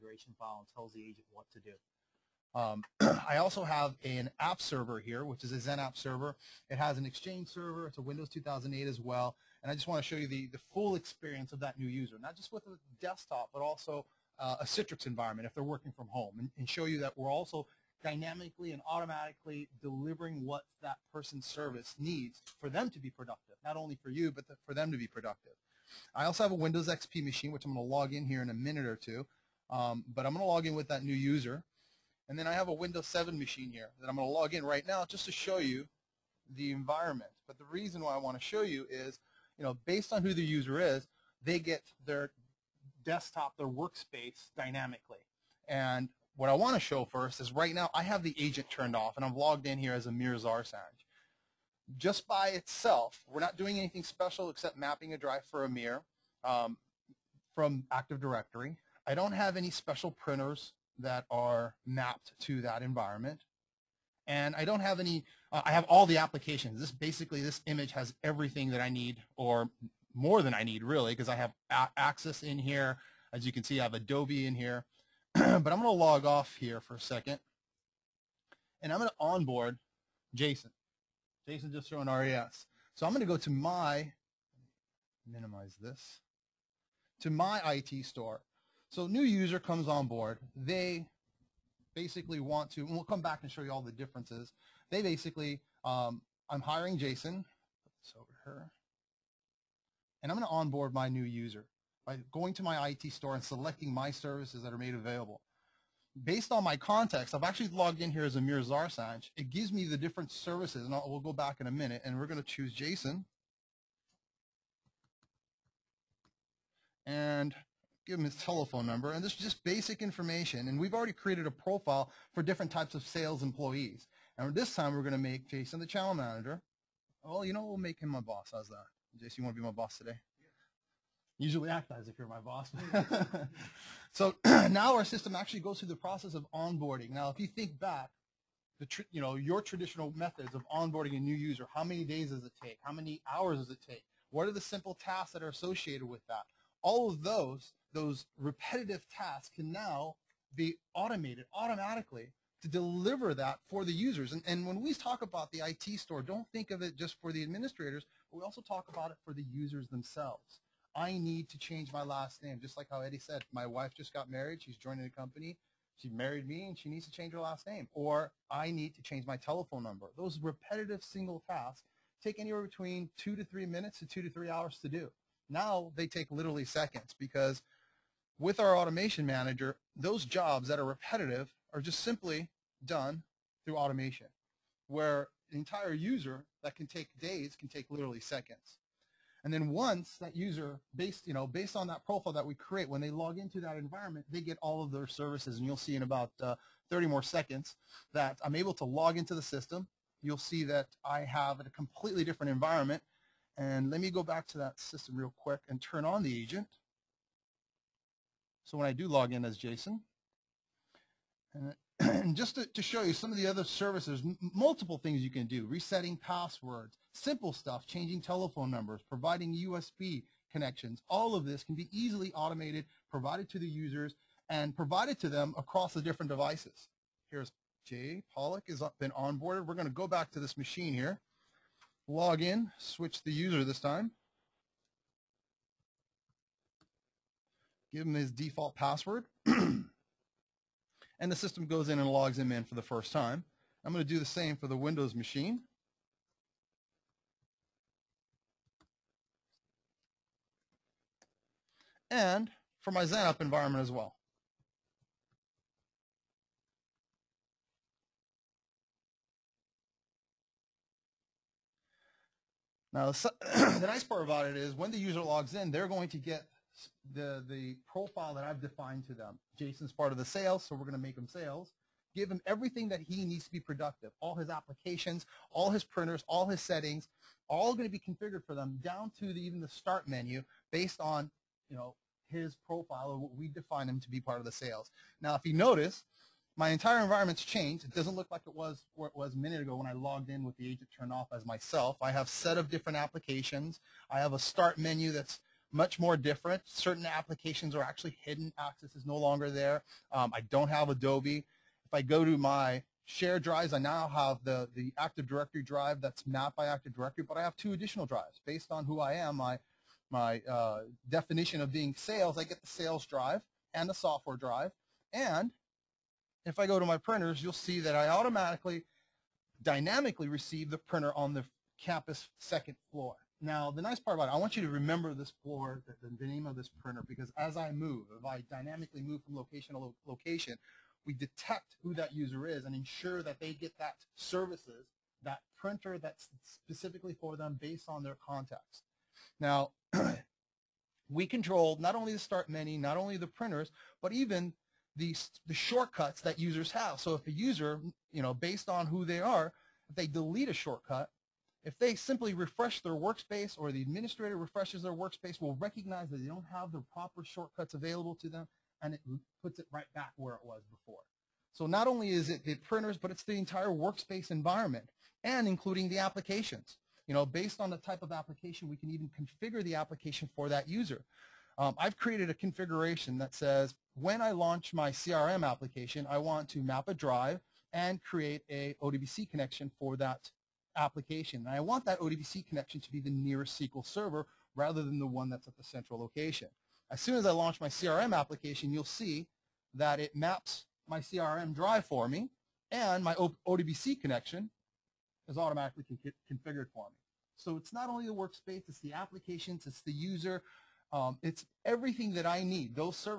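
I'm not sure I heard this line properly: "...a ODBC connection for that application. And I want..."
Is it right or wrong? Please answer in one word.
right.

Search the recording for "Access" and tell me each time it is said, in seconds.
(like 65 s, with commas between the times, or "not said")
71 s, 298 s.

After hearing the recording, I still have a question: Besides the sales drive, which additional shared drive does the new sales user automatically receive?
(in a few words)
software drive.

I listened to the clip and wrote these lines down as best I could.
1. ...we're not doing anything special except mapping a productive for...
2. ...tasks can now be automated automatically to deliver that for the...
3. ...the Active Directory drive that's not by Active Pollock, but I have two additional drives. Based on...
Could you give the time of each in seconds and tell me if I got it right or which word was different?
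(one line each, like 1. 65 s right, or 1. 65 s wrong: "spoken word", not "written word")
1. 53 s wrong: "drive", not "productive"
2. 149 s right
3. 304 s wrong: "Directory", not "Pollock".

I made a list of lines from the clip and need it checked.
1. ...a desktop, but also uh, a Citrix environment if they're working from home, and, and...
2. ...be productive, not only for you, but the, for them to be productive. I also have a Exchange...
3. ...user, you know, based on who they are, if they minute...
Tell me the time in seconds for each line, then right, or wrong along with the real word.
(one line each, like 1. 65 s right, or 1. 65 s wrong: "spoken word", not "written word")
1. 12 s right
2. 22 s wrong: "Windows", not "Exchange"
3. 347 s wrong: "delete", not "minute".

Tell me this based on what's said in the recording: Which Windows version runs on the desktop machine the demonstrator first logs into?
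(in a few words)
Windows 7.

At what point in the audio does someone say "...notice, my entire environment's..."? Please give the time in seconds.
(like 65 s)
285 s.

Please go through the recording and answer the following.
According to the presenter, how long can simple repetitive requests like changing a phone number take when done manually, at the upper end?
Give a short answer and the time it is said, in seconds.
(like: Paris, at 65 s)
2 to 3 hours, at 174 s.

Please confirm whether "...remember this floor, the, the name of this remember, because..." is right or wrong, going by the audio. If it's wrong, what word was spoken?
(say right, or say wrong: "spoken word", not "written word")
wrong: "printer", not "remember".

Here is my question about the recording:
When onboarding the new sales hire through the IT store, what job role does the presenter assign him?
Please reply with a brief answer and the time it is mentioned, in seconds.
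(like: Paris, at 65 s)
channel manager, at 125 s.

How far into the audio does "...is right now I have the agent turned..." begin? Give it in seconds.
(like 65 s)
47 s.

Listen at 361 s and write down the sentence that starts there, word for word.
So not only is it the printers, but it's the entire workspace environment and including the applications.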